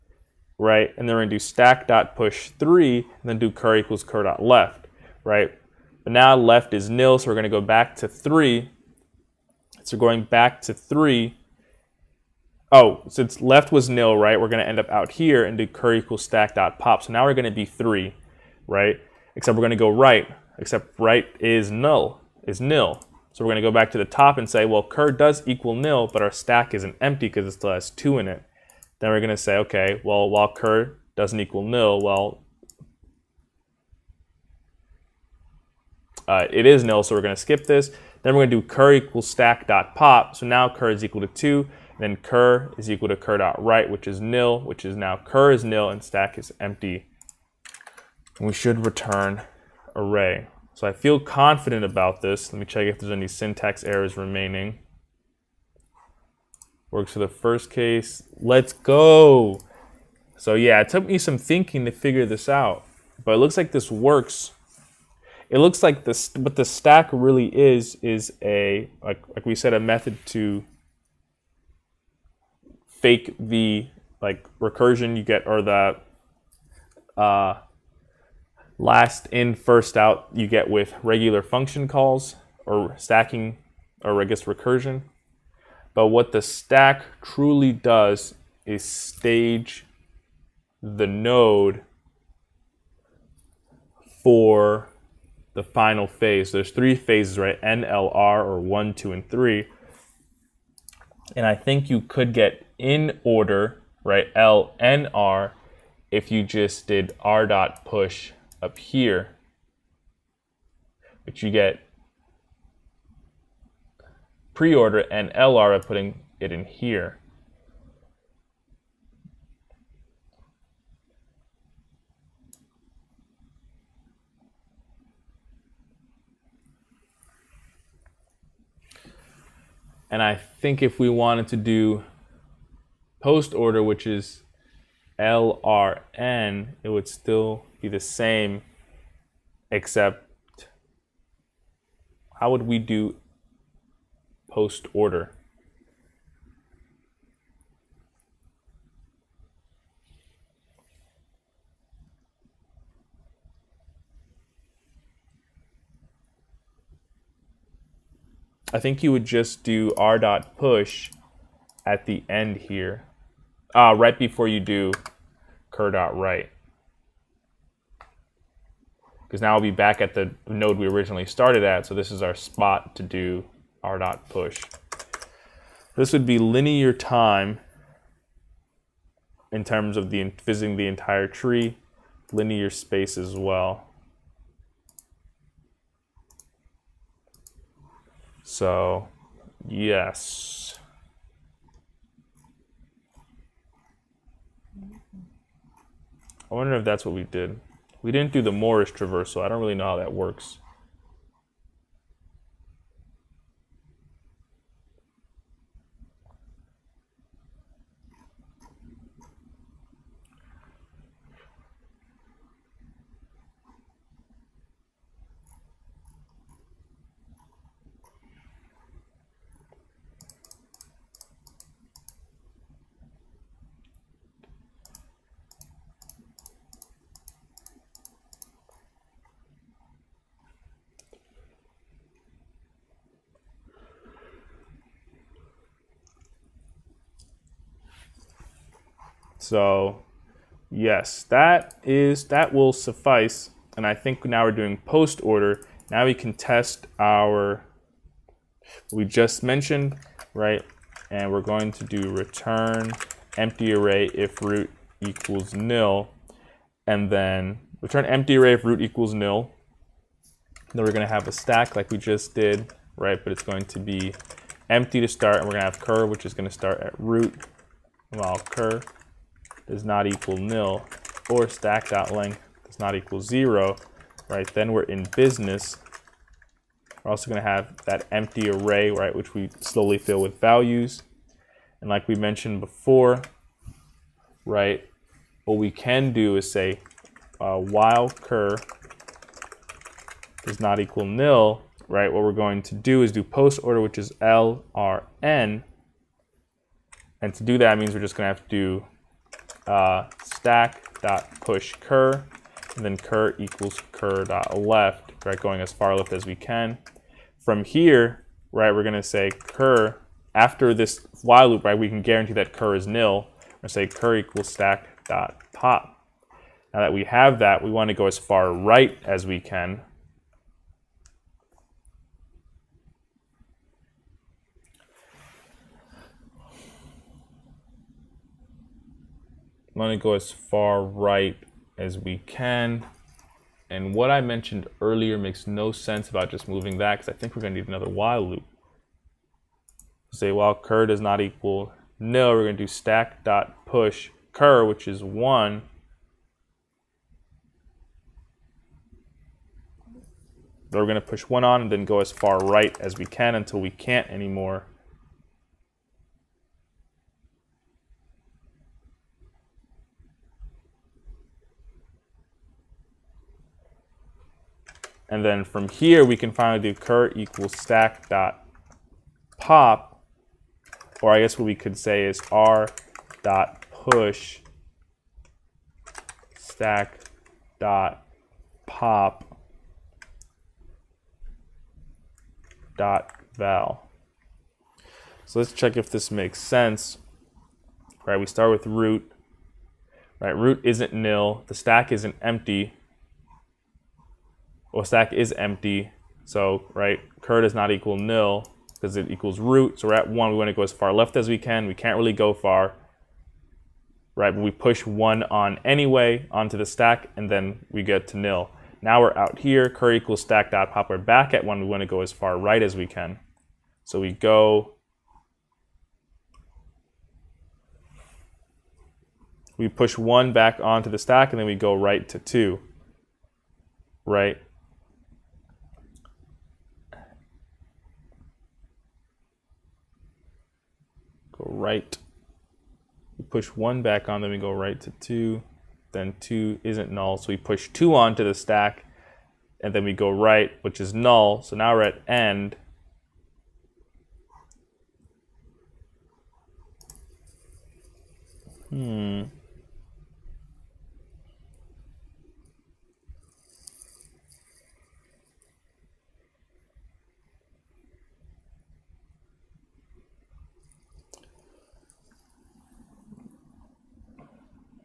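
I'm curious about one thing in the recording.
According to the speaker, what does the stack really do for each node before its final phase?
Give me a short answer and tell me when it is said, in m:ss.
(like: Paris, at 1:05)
stage the node, at 1:28.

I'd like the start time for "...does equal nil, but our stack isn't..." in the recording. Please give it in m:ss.
0:25.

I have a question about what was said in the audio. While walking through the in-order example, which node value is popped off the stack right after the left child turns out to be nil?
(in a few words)
3.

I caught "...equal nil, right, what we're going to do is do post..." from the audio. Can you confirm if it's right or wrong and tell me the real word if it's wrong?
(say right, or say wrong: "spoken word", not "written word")
right.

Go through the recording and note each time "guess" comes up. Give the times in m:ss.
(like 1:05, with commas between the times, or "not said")
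1:24, 6:11.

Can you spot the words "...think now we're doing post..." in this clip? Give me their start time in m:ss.
4:03.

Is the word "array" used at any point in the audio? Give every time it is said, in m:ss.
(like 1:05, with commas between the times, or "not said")
0:49, 4:13, 4:18, 4:38.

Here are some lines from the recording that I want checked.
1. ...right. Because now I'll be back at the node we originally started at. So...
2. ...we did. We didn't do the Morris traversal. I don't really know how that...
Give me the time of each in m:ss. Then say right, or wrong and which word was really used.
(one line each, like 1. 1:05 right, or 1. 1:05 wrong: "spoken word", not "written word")
1. 2:46 right
2. 3:17 right.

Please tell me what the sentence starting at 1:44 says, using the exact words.
LNR if you just did r dot push up here, which you get pre-order and LR by putting it in here.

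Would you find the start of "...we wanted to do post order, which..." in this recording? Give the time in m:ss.
2:10.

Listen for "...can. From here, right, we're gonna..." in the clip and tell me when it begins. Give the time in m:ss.
5:06.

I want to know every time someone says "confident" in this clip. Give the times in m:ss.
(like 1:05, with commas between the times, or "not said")
0:51.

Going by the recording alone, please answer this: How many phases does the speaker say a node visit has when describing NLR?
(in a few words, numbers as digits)
3.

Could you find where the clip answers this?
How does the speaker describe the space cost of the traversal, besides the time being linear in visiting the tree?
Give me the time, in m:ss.
3:02.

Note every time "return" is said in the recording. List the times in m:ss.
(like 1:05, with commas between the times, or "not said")
0:48, 4:12, 4:17.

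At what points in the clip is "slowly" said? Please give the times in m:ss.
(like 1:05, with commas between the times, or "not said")
4:39.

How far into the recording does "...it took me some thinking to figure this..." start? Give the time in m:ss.
1:00.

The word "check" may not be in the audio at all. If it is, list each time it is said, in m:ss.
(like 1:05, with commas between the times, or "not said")
0:52, 6:25.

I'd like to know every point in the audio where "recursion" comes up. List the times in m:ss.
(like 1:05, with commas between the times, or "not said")
1:14, 1:24.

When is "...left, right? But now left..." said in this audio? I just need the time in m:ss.
0:04.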